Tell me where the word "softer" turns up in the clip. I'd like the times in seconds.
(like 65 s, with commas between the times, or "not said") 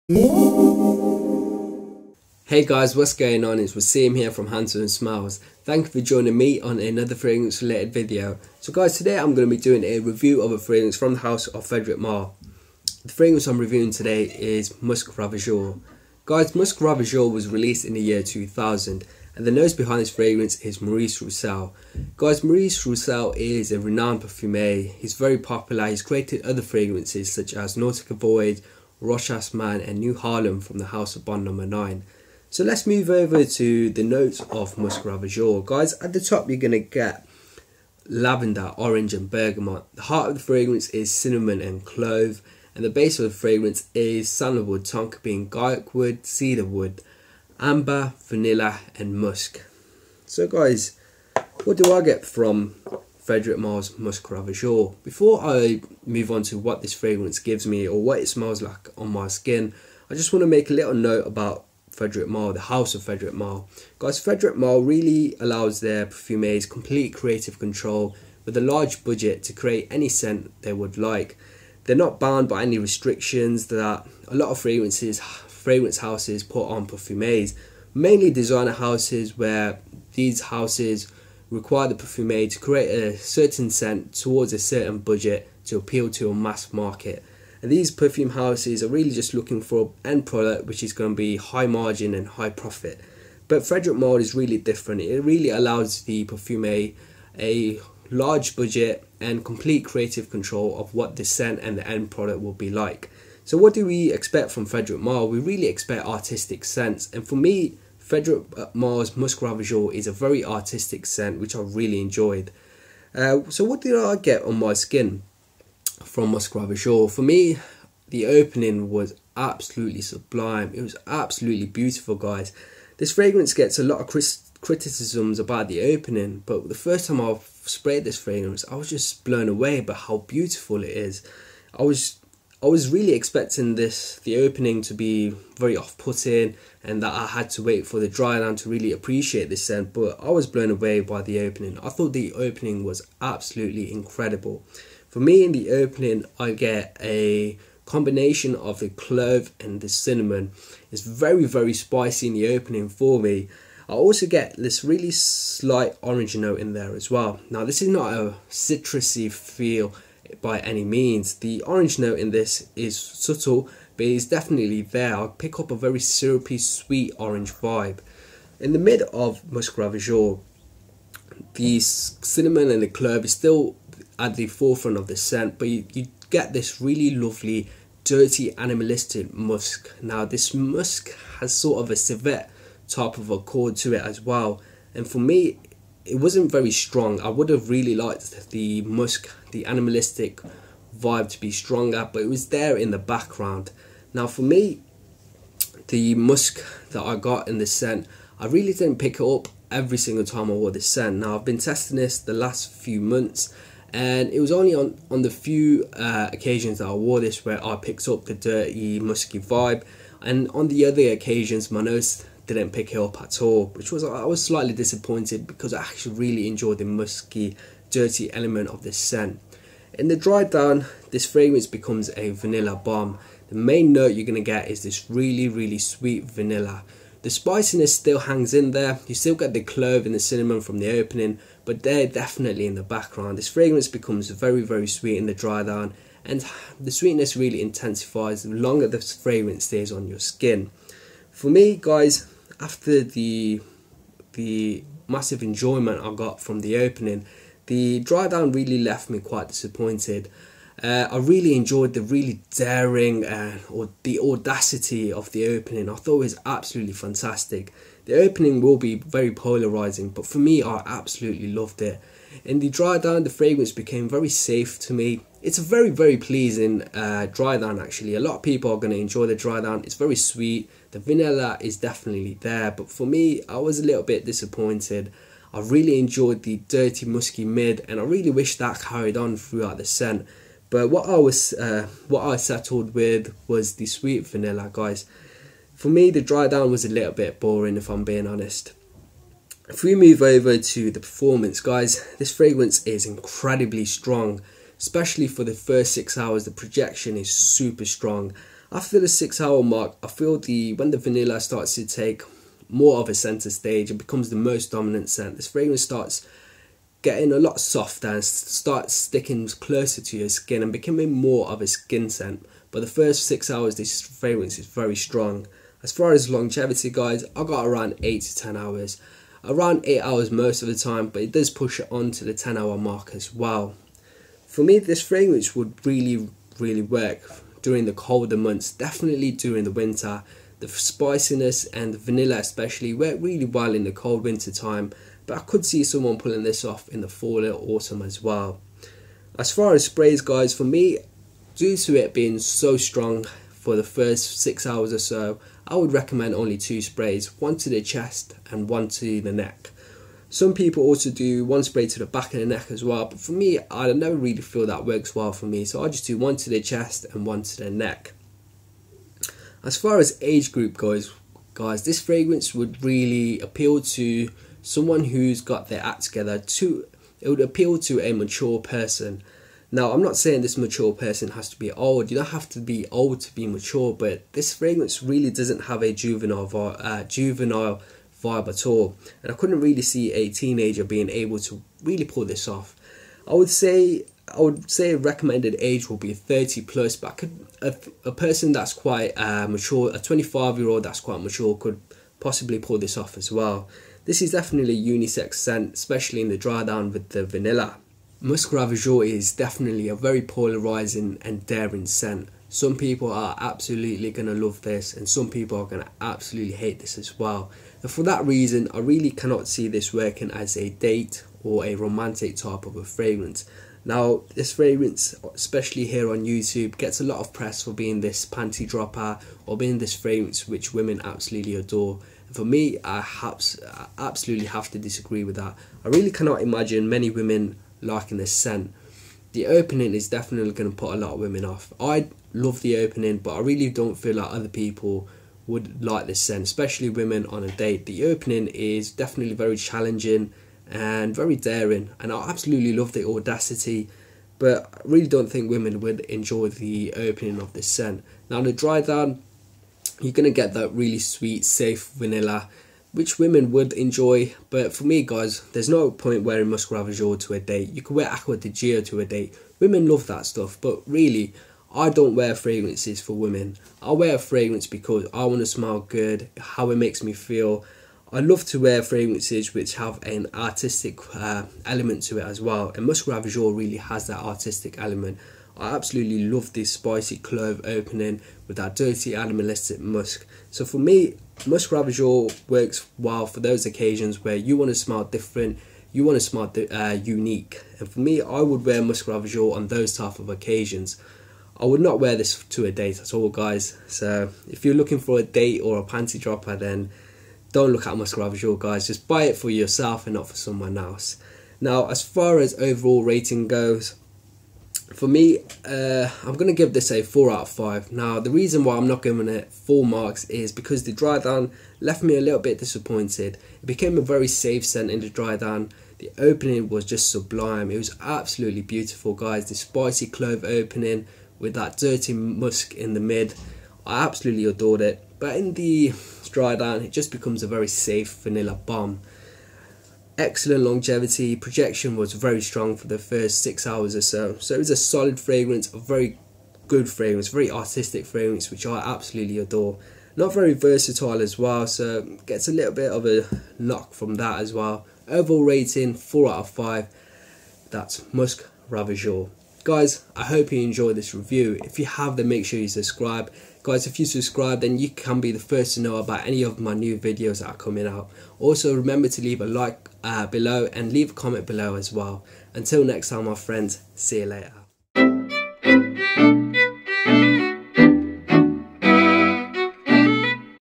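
307 s.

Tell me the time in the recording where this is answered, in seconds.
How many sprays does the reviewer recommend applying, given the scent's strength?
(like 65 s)
346 s.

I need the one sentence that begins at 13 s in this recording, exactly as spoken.
The fragrance I'm reviewing today is Musc Ravageur.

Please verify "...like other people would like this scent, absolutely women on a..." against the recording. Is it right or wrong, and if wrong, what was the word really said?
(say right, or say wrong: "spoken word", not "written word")
wrong: "especially", not "absolutely".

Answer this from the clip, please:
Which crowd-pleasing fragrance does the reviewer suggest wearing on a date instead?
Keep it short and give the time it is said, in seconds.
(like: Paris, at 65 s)
Acqua di Giò, at 458 s.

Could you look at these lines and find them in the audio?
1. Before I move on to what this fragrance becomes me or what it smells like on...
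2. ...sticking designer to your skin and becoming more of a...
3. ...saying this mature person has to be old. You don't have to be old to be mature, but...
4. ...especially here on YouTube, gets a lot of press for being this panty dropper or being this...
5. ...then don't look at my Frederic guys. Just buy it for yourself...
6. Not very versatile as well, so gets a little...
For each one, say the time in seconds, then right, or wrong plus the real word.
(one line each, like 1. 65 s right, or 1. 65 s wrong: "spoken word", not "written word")
1. 55 s wrong: "gives", not "becomes"
2. 308 s wrong: "closer", not "designer"
3. 370 s right
4. 415 s right
5. 496 s wrong: "Scribe", not "Frederic"
6. 540 s right.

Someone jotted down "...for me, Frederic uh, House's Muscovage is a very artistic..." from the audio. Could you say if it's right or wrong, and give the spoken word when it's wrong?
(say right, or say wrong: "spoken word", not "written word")
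wrong: "Malle", not "House".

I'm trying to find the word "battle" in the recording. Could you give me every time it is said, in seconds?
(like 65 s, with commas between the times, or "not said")
not said.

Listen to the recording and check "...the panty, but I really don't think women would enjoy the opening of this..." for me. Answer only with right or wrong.
wrong.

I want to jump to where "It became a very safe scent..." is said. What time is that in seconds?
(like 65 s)
513 s.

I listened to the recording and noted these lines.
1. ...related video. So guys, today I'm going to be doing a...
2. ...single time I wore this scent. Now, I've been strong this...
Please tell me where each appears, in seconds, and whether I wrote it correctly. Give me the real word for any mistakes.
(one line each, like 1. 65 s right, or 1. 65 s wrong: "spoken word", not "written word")
1. 7 s right
2. 199 s wrong: "testing", not "strong".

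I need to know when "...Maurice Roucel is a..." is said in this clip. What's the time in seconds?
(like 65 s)
22 s.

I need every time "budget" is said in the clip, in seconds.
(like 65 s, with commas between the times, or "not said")
69 s, 84 s, 98 s.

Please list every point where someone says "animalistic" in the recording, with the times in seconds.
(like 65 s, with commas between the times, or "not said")
178 s, 189 s, 479 s.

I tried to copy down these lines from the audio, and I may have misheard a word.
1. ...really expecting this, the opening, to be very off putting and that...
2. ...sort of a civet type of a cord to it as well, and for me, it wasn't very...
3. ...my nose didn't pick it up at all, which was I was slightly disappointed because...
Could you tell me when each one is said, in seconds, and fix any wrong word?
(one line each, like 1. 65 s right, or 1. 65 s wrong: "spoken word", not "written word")
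1. 132 s right
2. 181 s right
3. 211 s right.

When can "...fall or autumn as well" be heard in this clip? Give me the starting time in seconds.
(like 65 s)
337 s.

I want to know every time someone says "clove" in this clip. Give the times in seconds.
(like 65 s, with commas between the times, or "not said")
41 s, 148 s, 172 s, 229 s, 477 s, 520 s.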